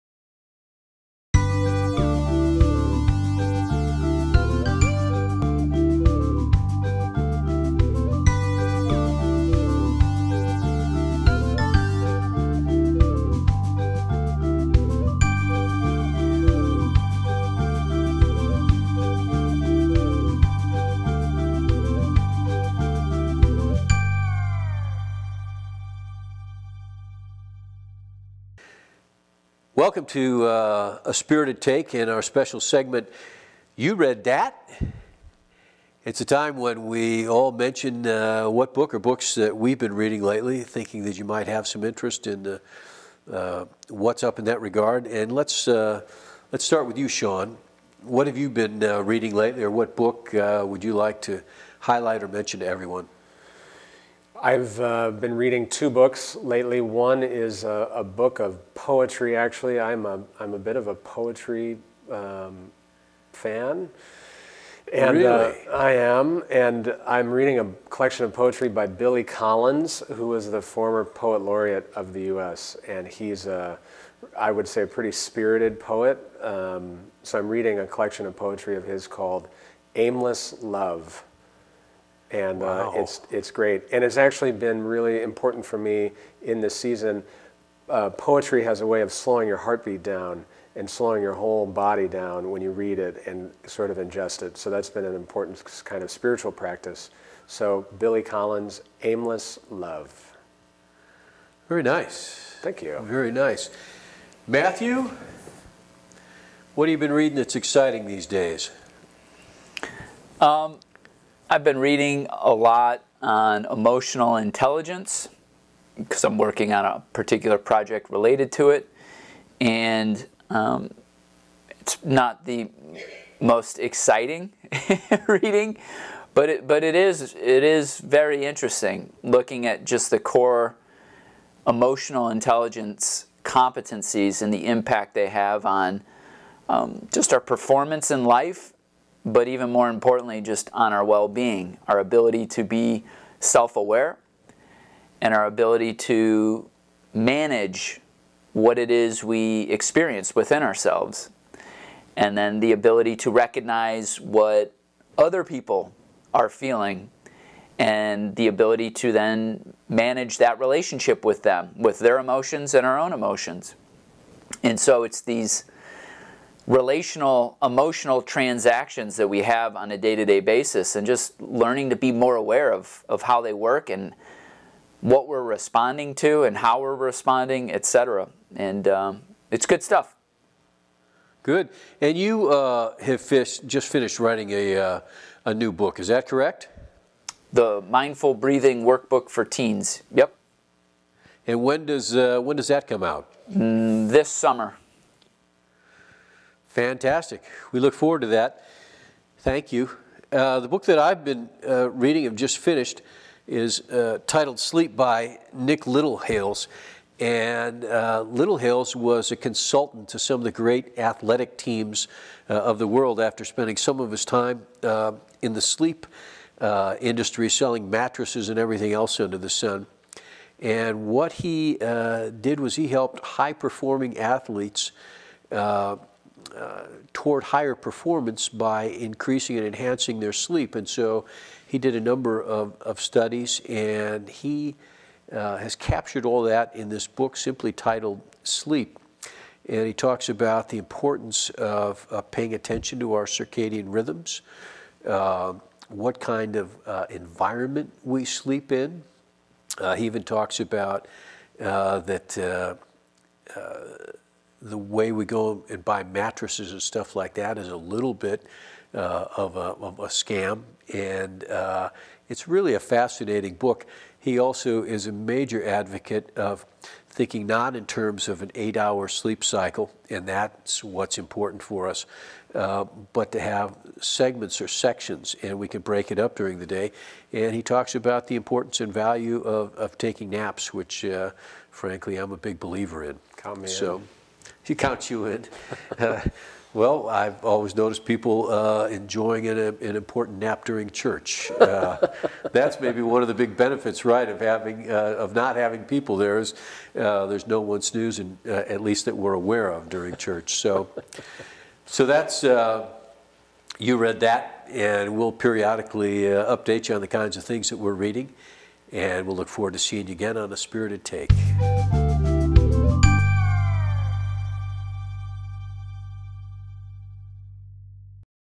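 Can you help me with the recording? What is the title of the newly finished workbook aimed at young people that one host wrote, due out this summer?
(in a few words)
The Mindful Breathing Workbook for Teens.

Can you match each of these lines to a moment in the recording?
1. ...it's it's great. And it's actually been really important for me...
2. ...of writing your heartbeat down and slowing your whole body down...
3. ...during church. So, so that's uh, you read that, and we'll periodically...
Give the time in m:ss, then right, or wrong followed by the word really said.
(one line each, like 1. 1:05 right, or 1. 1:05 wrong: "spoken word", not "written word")
1. 1:23 right
2. 1:29 wrong: "slowing", not "writing"
3. 4:59 right.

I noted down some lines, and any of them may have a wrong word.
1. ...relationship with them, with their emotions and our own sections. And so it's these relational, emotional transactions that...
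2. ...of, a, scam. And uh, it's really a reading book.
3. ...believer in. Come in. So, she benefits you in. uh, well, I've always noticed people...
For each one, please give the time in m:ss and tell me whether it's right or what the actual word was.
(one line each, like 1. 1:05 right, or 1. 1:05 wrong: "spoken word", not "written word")
1. 2:40 wrong: "emotions", not "sections"
2. 4:19 wrong: "fascinating", not "reading"
3. 4:42 wrong: "counts", not "benefits".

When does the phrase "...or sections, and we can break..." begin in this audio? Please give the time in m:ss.
4:34.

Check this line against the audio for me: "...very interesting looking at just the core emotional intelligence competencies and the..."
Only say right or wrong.
right.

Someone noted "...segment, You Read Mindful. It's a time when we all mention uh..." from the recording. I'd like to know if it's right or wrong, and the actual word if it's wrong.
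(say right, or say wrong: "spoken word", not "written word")
wrong: "That", not "Mindful".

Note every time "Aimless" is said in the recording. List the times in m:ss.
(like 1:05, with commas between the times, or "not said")
1:19, 1:39.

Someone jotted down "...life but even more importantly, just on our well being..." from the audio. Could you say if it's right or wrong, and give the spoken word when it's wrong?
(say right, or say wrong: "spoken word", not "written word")
right.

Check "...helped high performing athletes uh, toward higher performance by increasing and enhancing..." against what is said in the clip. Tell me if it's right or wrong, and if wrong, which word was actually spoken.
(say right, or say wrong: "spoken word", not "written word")
right.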